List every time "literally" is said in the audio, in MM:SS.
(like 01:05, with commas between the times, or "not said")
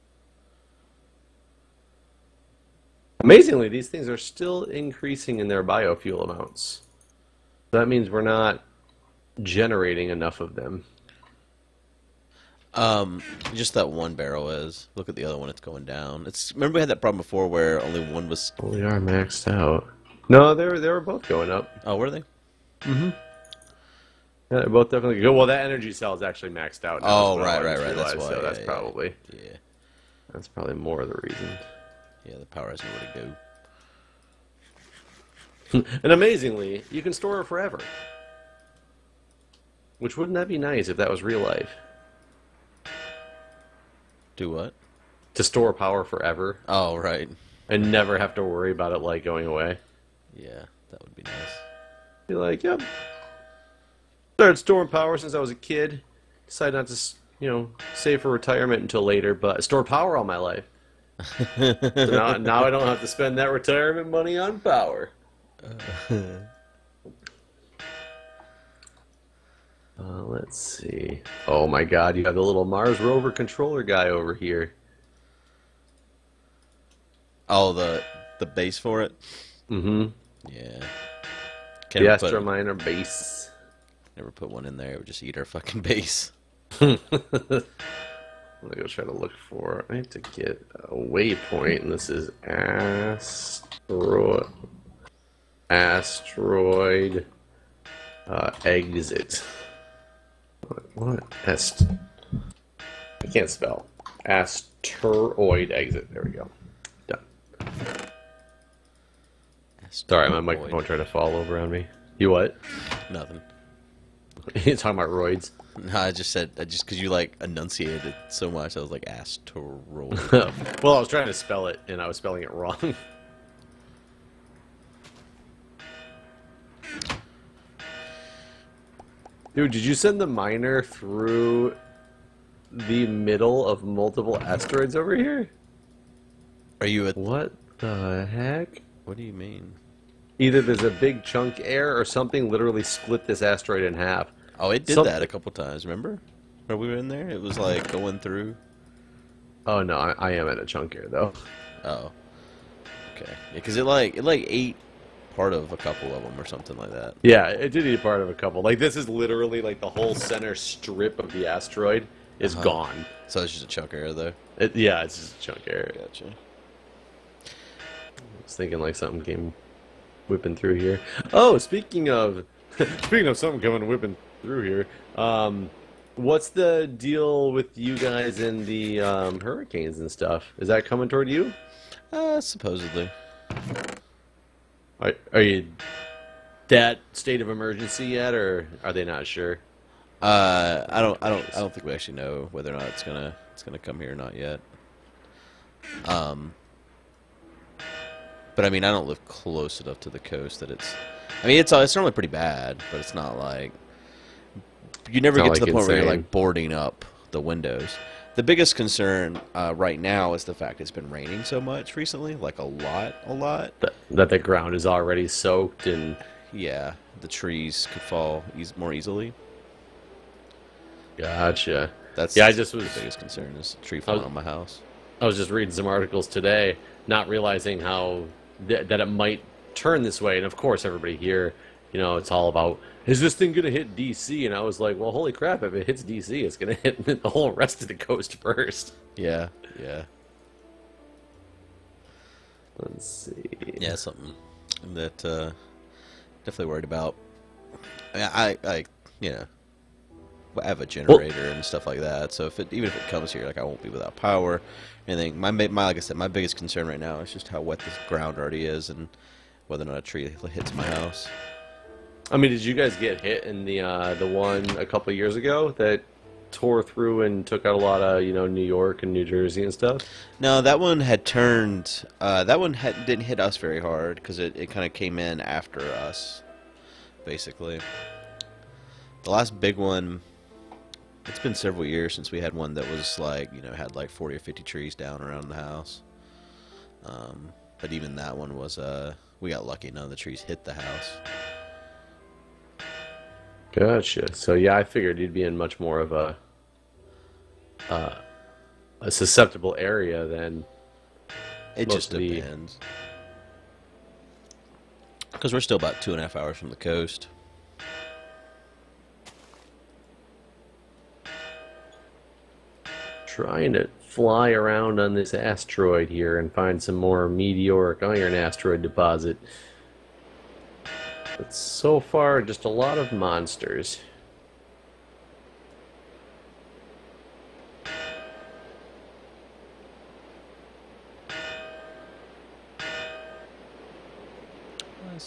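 02:22, 02:39.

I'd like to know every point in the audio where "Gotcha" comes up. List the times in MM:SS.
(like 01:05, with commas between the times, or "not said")
02:45, 03:41, 04:53.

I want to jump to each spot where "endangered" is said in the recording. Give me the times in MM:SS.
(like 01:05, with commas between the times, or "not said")
not said.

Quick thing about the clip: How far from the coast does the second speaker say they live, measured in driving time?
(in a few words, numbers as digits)
2.5 hours.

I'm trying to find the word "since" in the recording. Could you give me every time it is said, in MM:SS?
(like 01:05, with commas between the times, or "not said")
00:55, 04:42.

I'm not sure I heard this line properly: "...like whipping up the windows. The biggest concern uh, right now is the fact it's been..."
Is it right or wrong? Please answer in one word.
wrong.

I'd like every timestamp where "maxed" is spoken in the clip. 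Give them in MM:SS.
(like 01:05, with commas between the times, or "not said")
00:18, 00:26.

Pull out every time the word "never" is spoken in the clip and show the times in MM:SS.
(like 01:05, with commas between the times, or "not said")
00:47, 01:24, 03:25.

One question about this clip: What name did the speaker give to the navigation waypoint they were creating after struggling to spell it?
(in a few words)
Asteroid exit.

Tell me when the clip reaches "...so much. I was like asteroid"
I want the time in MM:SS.
01:58.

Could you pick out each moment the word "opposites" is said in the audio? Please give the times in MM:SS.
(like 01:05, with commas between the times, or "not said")
not said.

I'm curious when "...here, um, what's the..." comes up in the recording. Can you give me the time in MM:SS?
02:54.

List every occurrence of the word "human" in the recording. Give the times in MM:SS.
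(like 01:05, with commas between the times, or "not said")
not said.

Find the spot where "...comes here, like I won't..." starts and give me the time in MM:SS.
04:13.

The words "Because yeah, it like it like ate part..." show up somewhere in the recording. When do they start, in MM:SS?
02:33.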